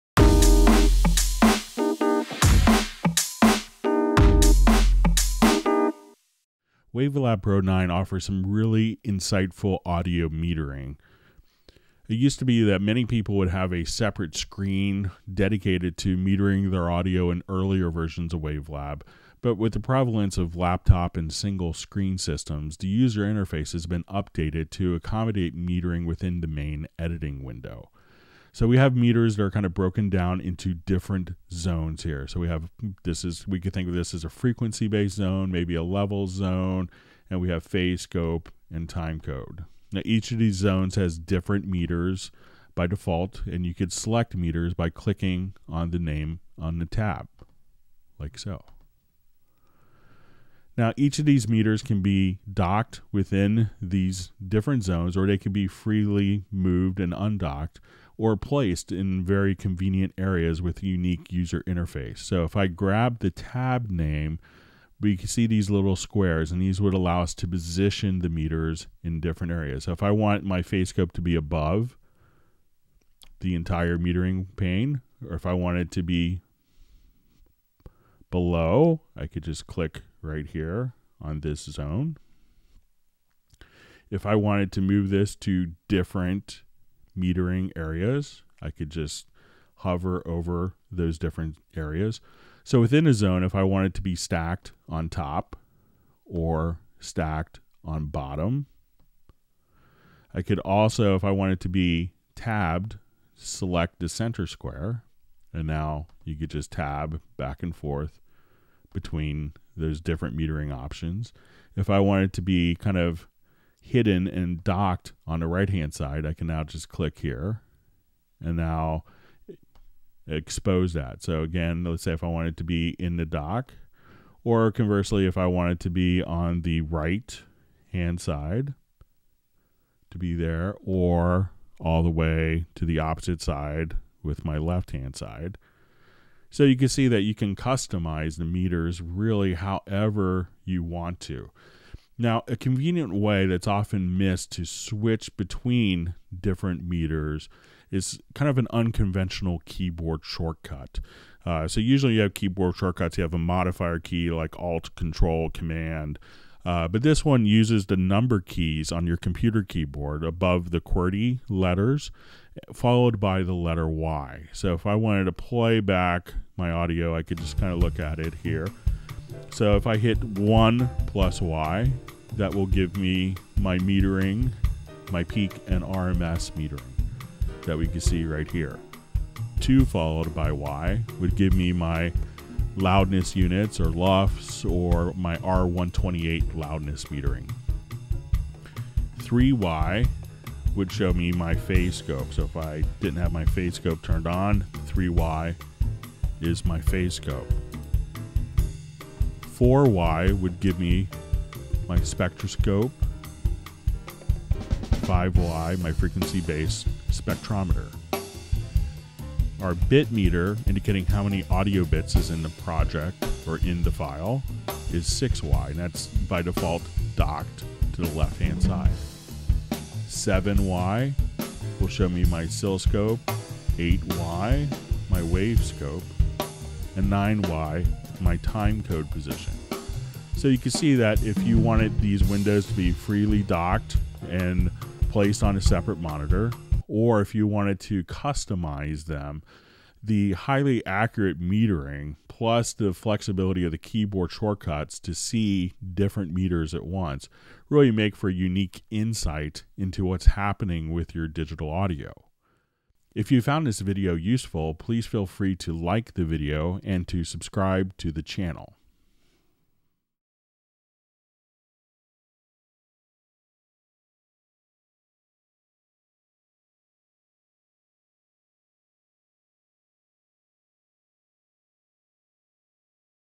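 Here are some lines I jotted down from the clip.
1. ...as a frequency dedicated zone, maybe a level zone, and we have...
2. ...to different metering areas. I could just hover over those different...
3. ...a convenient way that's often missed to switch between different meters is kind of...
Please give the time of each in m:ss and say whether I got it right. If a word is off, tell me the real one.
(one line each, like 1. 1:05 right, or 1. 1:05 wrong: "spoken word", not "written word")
1. 0:34 wrong: "based", not "dedicated"
2. 1:25 right
3. 2:22 right.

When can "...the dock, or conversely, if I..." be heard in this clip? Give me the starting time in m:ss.
2:03.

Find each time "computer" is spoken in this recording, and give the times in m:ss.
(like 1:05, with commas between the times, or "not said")
2:39.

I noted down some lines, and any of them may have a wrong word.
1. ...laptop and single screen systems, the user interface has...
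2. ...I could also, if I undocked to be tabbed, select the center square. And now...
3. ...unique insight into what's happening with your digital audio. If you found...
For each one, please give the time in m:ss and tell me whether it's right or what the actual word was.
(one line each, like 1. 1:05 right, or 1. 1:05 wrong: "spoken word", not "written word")
1. 0:20 right
2. 1:40 wrong: "wanted", not "undocked"
3. 4:08 right.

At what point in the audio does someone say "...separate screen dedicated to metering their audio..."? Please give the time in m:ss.
0:13.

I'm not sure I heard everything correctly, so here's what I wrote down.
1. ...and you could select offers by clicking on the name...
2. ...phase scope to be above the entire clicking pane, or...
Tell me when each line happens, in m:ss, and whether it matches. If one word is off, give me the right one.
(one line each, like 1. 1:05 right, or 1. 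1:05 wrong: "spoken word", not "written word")
1. 0:43 wrong: "meters", not "offers"
2. 1:10 wrong: "metering", not "clicking".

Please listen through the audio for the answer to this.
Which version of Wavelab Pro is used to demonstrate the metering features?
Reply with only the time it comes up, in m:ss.
0:06.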